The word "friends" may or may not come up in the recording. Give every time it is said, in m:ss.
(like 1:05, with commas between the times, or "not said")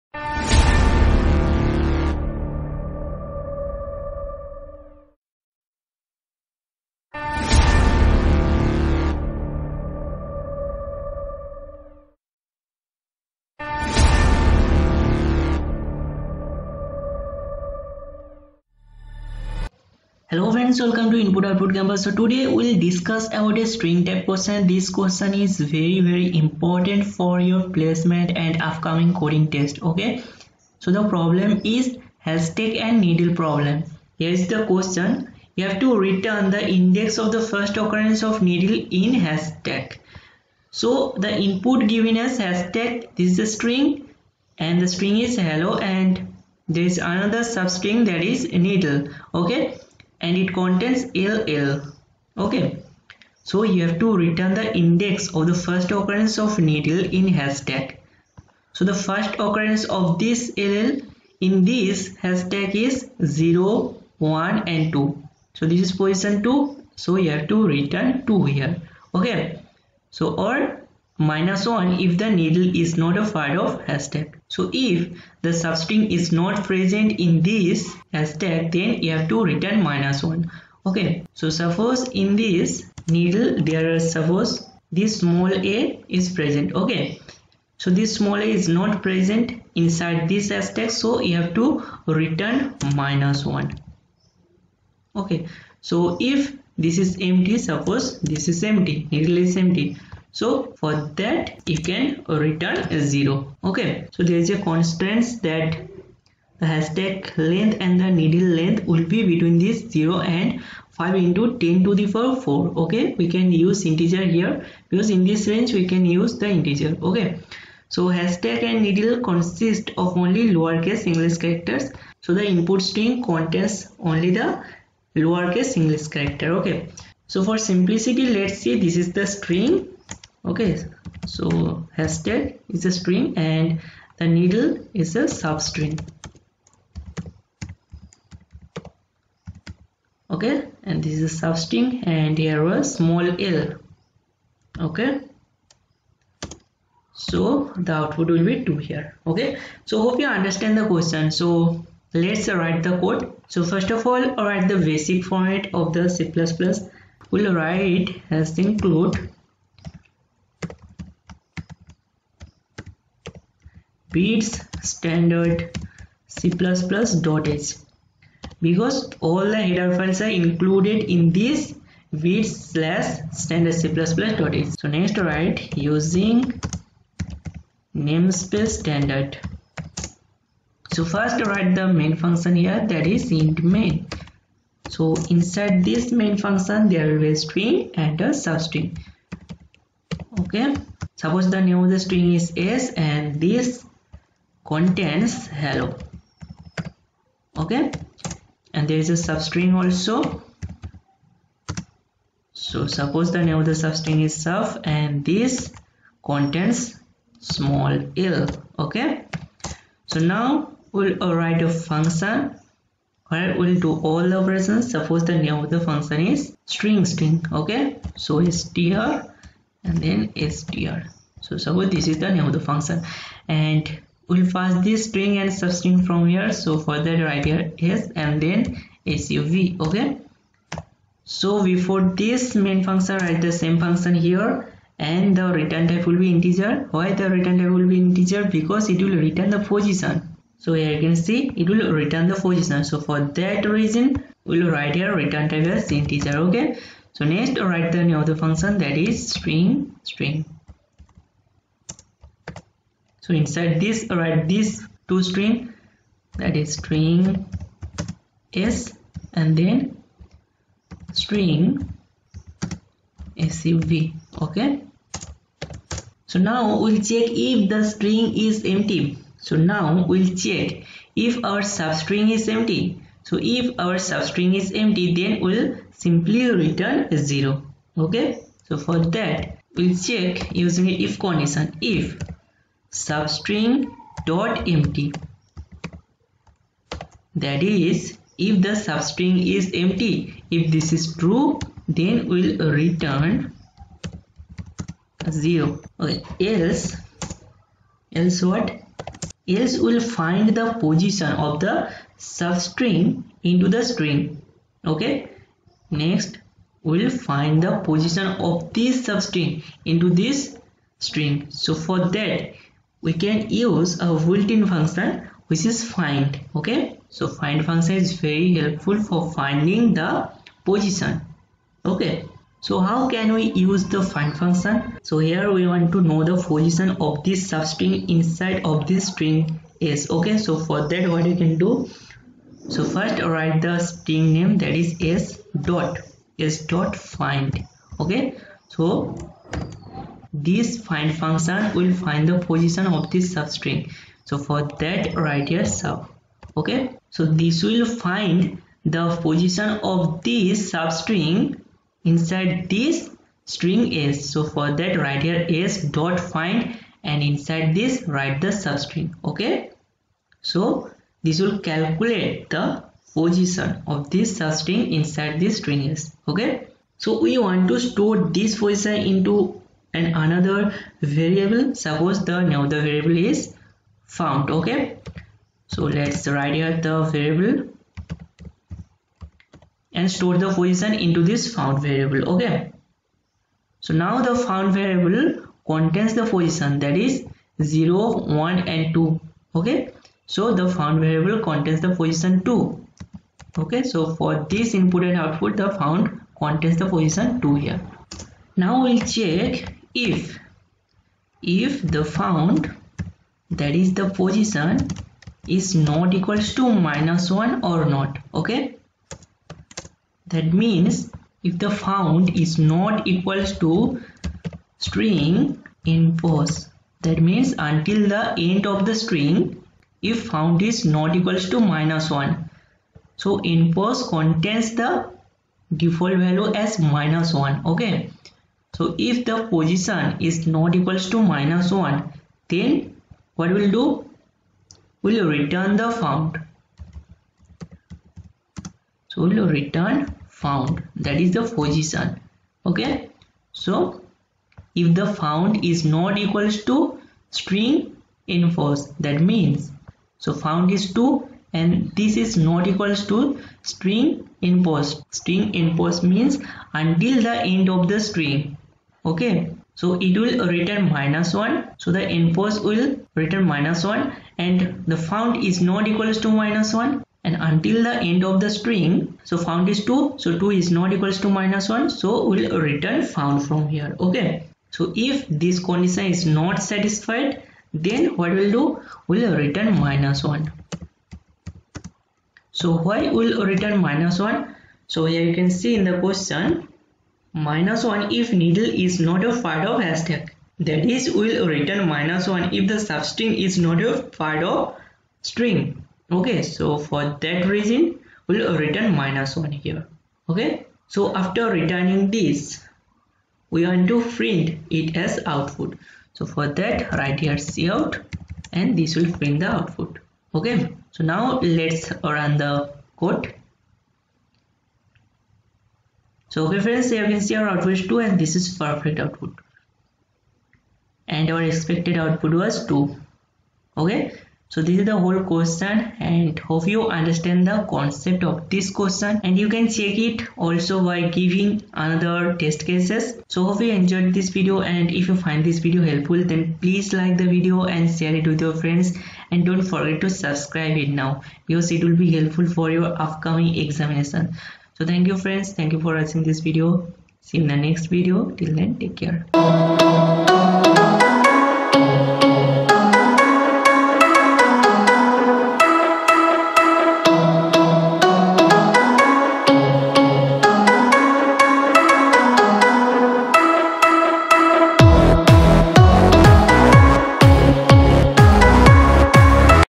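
0:20, 8:36, 8:58, 9:05.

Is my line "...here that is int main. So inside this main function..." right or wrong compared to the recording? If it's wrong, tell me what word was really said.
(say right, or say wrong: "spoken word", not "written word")
right.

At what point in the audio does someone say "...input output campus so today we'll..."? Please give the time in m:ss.
0:21.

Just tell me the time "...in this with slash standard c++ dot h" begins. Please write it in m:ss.
2:51.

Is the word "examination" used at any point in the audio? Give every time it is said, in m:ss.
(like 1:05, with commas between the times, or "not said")
9:03.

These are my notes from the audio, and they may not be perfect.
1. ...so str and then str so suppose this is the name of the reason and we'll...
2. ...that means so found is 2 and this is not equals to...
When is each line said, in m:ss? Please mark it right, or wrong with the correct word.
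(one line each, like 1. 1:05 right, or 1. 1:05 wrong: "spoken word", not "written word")
1. 3:38 wrong: "function", not "reason"
2. 7:28 right.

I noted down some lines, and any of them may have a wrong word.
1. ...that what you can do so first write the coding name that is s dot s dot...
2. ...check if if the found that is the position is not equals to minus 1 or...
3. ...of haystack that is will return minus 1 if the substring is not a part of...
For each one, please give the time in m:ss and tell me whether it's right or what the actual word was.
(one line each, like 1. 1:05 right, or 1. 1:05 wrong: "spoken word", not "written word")
1. 5:30 wrong: "string", not "coding"
2. 6:39 right
3. 8:09 right.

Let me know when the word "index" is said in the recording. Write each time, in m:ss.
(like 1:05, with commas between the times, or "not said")
0:36, 0:54.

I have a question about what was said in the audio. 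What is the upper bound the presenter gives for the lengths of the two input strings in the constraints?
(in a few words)
5 into 10 to the power 4.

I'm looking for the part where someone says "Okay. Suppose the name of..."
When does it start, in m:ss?
3:10.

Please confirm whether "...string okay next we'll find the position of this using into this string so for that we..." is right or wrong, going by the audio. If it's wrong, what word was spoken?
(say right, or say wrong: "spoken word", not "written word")
wrong: "substring", not "using".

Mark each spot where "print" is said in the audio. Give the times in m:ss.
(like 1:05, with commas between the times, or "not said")
8:24, 8:29.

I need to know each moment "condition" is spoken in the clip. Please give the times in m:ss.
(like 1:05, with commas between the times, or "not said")
4:41, 7:55.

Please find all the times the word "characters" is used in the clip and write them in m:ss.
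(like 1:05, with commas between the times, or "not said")
2:01, 2:06.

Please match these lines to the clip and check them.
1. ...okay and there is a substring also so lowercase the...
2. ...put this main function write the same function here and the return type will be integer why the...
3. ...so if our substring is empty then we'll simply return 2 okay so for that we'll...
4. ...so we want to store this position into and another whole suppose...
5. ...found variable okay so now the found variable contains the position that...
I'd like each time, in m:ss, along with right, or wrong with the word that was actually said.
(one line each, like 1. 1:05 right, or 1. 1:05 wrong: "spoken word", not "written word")
1. 3:17 wrong: "suppose", not "lowercase"
2. 3:51 right
3. 4:33 wrong: "0", not "2"
4. 6:06 wrong: "variable", not "whole"
5. 6:21 right.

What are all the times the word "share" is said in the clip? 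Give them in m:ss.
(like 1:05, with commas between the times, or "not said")
8:57.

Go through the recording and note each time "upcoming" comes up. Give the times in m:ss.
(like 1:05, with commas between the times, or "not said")
0:28, 9:03.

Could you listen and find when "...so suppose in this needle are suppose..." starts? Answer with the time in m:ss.
1:21.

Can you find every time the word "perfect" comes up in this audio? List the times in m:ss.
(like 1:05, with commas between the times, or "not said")
8:38.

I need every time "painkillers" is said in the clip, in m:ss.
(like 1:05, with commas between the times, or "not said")
not said.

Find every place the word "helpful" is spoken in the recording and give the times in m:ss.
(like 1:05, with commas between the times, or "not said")
5:18, 8:55, 9:02.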